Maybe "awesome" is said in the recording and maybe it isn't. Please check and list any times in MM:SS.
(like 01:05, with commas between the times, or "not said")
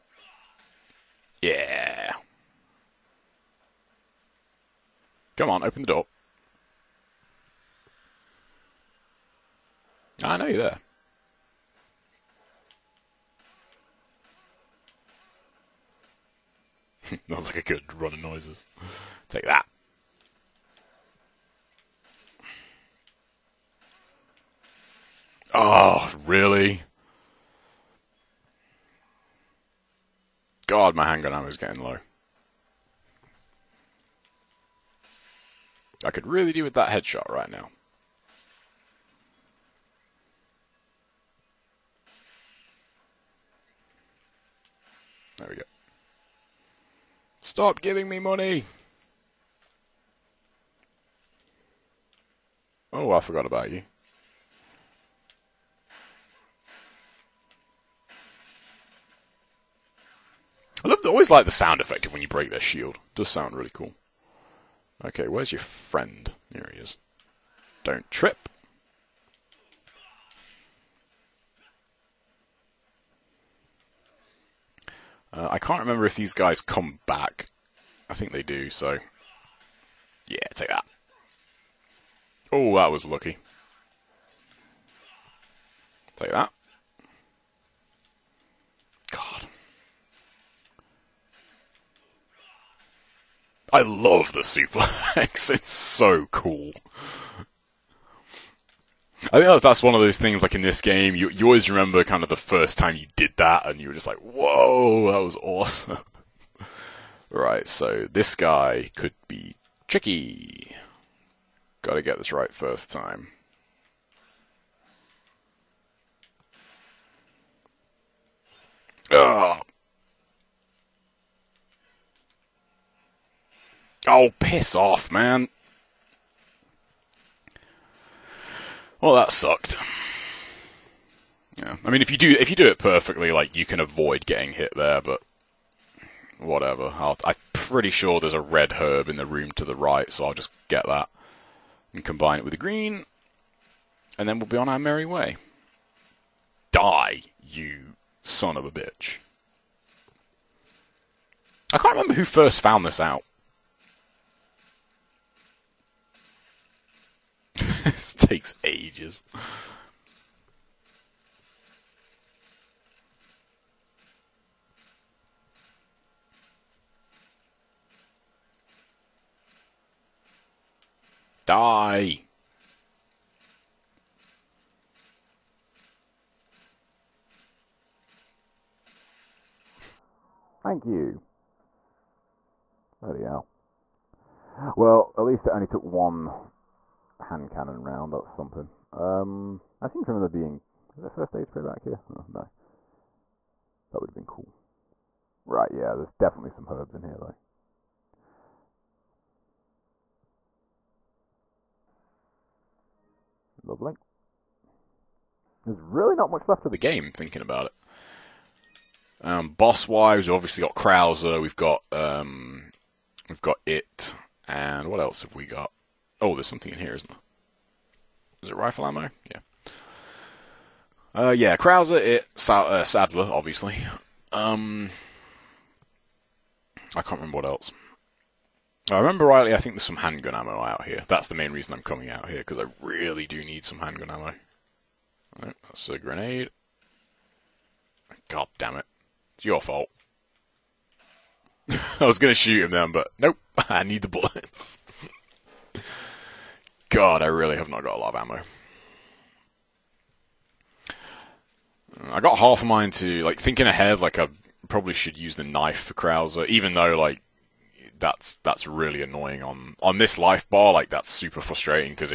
01:45.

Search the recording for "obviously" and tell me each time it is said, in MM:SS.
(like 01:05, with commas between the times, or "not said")
03:30, 03:43.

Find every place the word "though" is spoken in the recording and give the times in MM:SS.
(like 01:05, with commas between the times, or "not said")
03:17, 04:16.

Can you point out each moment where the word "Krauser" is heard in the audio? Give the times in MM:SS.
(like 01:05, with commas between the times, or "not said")
03:30, 03:41, 04:15.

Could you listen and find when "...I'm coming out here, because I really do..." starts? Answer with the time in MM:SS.
03:51.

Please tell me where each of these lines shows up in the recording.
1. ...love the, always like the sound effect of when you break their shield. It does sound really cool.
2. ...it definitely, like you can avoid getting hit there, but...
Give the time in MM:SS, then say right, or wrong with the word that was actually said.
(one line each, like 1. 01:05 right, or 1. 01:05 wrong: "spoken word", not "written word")
1. 01:00 right
2. 02:12 wrong: "perfectly", not "definitely".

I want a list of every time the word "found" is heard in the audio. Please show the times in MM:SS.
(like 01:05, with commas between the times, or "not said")
02:32.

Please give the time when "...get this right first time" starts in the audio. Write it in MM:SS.
01:52.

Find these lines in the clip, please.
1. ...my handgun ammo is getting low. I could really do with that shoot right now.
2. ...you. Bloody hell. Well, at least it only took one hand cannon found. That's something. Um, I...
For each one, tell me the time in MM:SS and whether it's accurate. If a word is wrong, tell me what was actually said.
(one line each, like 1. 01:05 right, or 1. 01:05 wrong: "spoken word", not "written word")
1. 00:30 wrong: "headshot", not "shoot"
2. 03:00 wrong: "round", not "found".